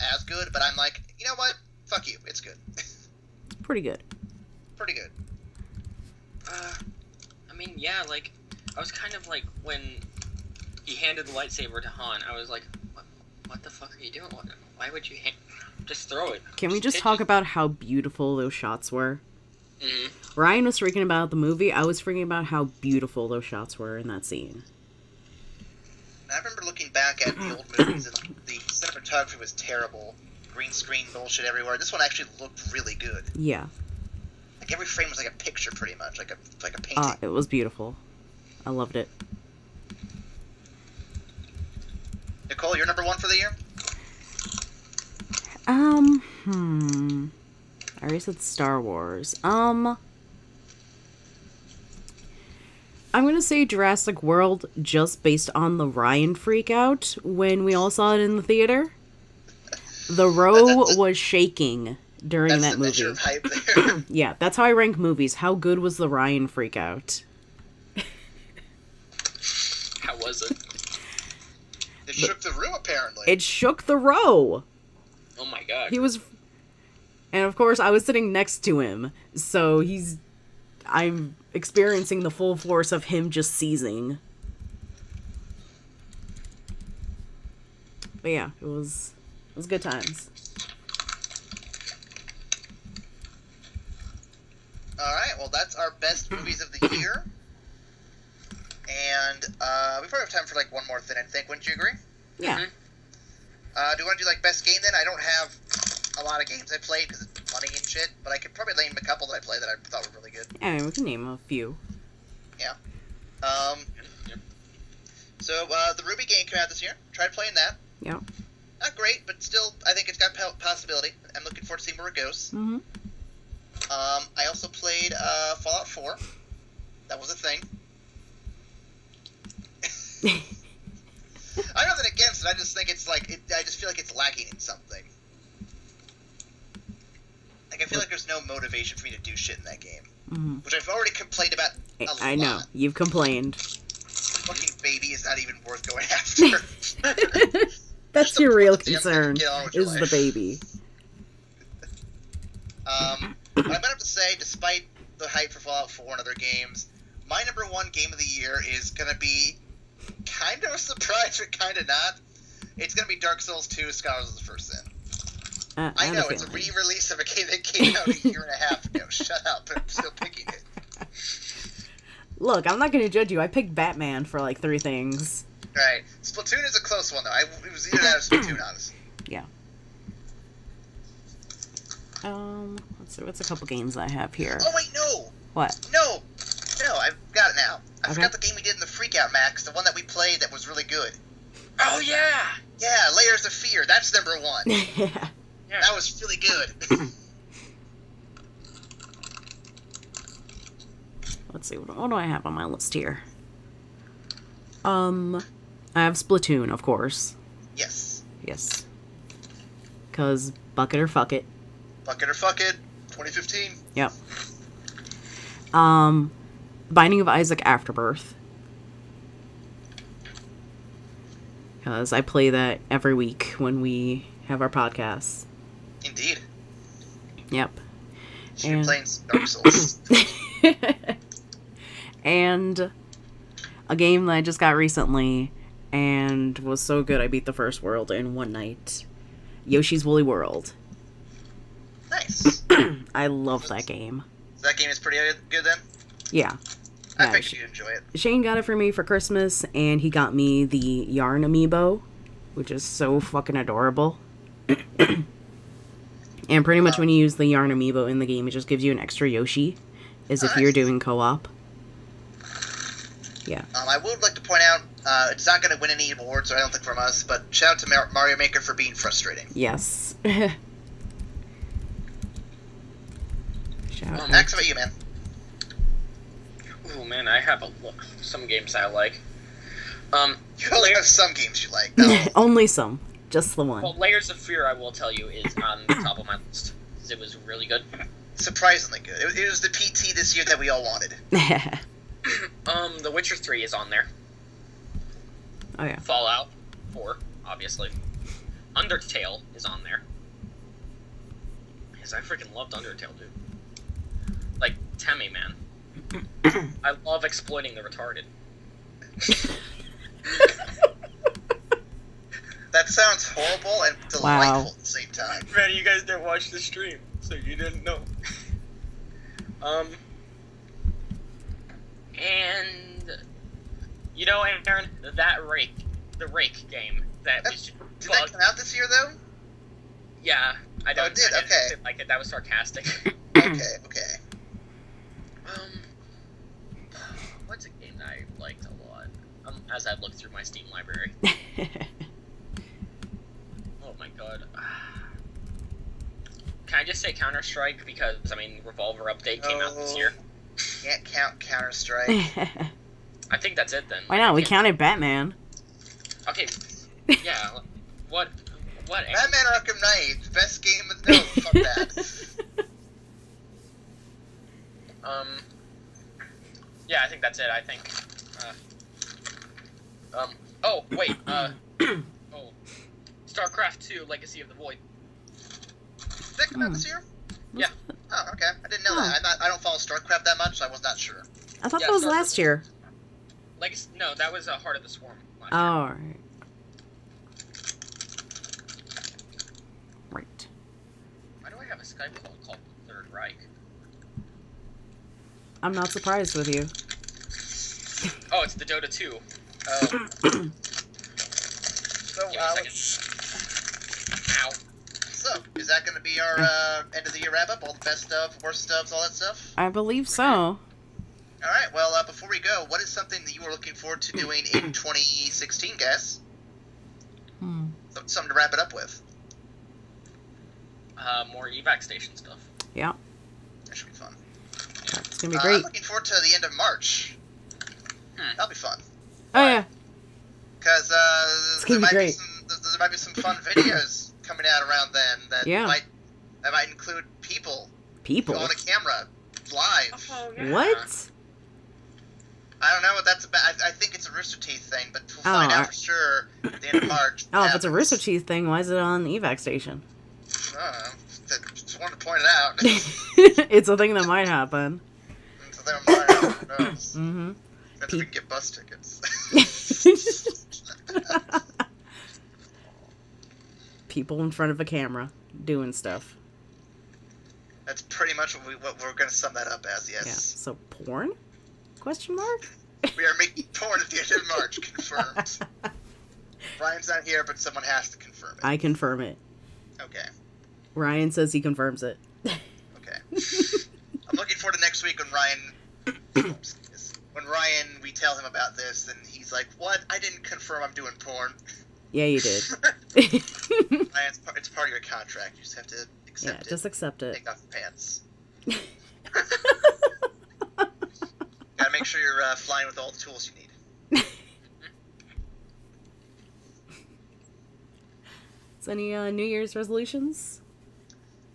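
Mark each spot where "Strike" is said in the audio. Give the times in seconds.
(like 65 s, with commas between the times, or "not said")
347 s, 351 s.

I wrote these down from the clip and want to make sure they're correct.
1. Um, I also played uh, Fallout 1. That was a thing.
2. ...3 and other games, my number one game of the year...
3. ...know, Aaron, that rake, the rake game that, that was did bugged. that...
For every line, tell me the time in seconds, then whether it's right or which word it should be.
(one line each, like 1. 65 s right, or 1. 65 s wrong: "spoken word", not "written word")
1. 122 s wrong: "4", not "1"
2. 155 s wrong: "4", not "3"
3. 324 s right.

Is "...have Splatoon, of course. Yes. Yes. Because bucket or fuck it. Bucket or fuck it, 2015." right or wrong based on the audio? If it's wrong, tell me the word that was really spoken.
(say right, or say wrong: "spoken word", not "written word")
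right.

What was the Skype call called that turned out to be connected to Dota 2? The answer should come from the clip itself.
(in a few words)
the Third Reich.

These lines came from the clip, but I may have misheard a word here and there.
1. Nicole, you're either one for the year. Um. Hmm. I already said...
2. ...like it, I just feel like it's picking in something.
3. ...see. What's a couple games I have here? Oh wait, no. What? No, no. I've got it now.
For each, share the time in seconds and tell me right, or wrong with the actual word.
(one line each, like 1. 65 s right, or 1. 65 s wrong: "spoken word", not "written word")
1. 42 s wrong: "number", not "either"
2. 133 s wrong: "lacking", not "picking"
3. 183 s right.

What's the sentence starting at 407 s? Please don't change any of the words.
All the best of, worst of, all that stuff.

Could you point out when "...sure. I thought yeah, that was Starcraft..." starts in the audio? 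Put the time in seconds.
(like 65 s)
380 s.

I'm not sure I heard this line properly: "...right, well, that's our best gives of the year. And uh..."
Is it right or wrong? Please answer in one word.
wrong.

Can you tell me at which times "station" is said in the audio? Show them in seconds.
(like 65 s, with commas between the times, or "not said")
421 s, 449 s.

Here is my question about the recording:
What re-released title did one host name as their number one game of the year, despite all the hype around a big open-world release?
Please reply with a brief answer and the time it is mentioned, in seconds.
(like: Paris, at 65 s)
Dark Souls 2: Scholars of the First Sin, at 163 s.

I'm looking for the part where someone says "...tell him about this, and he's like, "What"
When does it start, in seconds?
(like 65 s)
487 s.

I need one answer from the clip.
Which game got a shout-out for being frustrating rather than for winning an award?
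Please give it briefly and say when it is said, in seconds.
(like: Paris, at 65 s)
Mario Maker, at 268 s.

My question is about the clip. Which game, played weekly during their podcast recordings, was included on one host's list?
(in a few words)
Binding of Isaac Afterbirth.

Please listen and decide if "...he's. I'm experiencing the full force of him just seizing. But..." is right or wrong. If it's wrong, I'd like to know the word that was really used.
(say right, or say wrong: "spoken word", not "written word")
right.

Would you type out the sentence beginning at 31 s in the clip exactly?
This one actually looked really good.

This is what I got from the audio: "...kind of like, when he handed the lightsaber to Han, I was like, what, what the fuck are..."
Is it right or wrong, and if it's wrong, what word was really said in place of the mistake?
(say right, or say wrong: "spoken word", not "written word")
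right.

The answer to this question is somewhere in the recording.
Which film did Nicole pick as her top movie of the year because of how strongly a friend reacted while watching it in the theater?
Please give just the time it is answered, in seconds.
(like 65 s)
53 s.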